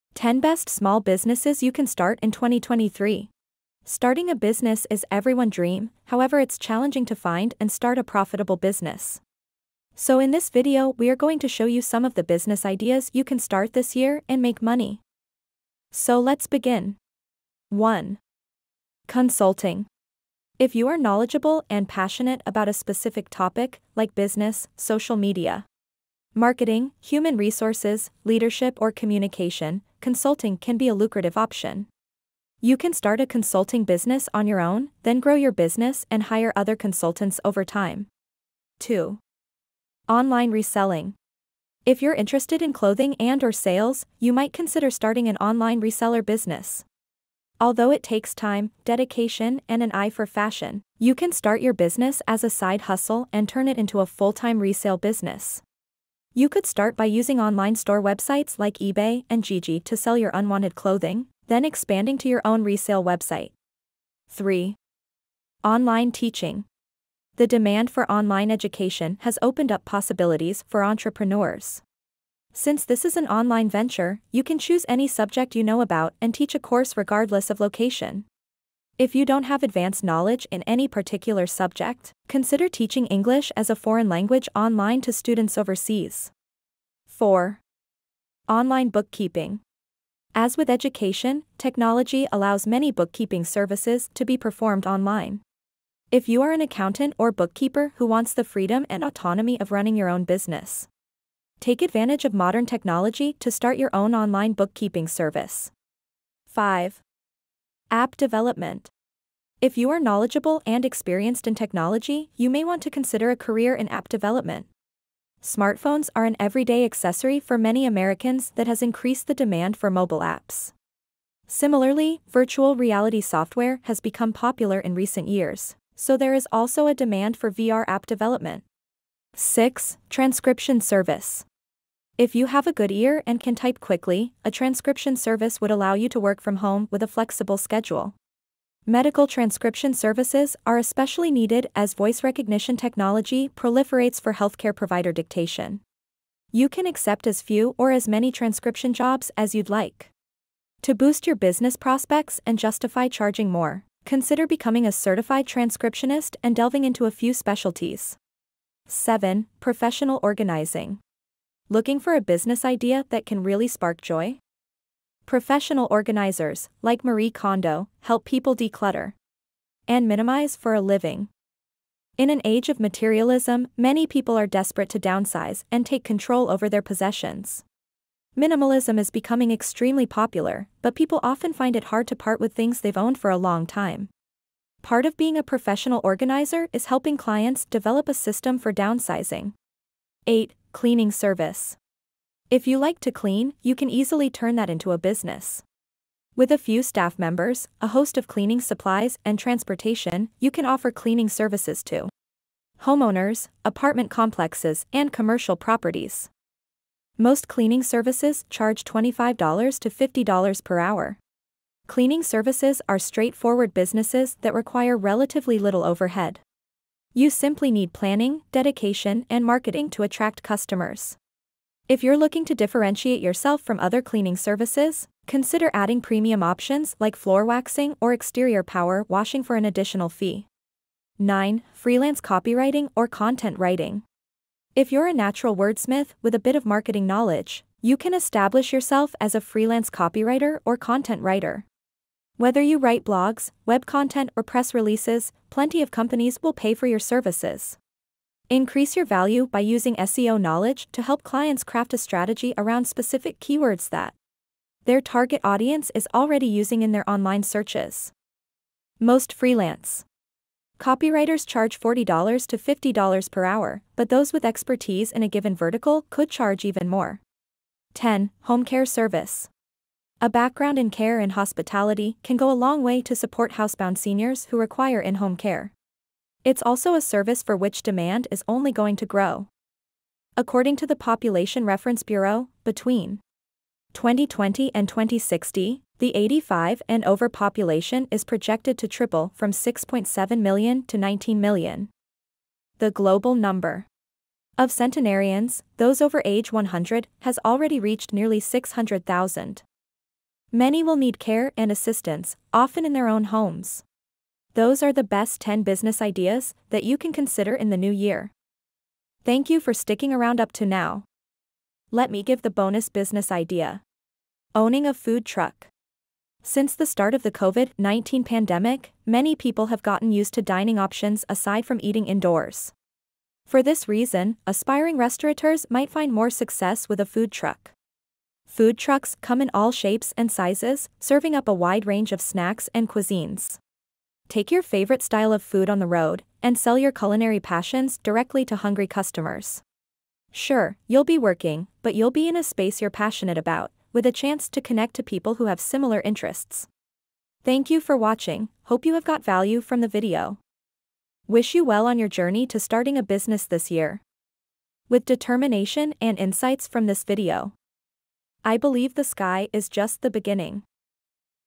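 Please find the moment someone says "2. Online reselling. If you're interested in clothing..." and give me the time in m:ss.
0:38.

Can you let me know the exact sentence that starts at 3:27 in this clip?
Most cleaning services charge $25 to $50 per hour.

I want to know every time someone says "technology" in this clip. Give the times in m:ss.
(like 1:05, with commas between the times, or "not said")
1:31, 1:42, 1:51, 2:22.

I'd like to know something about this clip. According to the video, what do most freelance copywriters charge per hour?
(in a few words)
$40 to $50.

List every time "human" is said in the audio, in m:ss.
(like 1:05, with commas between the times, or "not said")
0:26.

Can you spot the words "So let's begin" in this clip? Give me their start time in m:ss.
0:15.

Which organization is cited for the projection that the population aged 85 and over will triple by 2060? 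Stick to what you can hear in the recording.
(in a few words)
Population Reference Bureau.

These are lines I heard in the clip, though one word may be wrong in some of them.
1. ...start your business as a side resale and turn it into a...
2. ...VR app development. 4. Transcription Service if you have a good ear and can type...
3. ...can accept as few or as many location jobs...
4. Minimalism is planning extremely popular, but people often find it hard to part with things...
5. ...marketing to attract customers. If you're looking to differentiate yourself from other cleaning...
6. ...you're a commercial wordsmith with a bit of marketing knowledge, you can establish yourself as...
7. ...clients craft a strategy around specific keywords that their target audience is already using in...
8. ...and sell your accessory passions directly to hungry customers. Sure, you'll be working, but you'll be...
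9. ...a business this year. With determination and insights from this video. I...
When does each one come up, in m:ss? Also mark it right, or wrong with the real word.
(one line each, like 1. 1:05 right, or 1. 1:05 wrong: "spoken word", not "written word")
1. 0:51 wrong: "hustle", not "resale"
2. 2:07 wrong: "6", not "4"
3. 2:26 wrong: "transcription", not "location"
4. 2:58 wrong: "becoming", not "planning"
5. 3:39 right
6. 3:54 wrong: "natural", not "commercial"
7. 4:11 right
8. 5:36 wrong: "culinary", not "accessory"
9. 5:52 right.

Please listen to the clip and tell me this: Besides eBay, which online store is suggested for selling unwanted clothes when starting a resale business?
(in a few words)
Gigi.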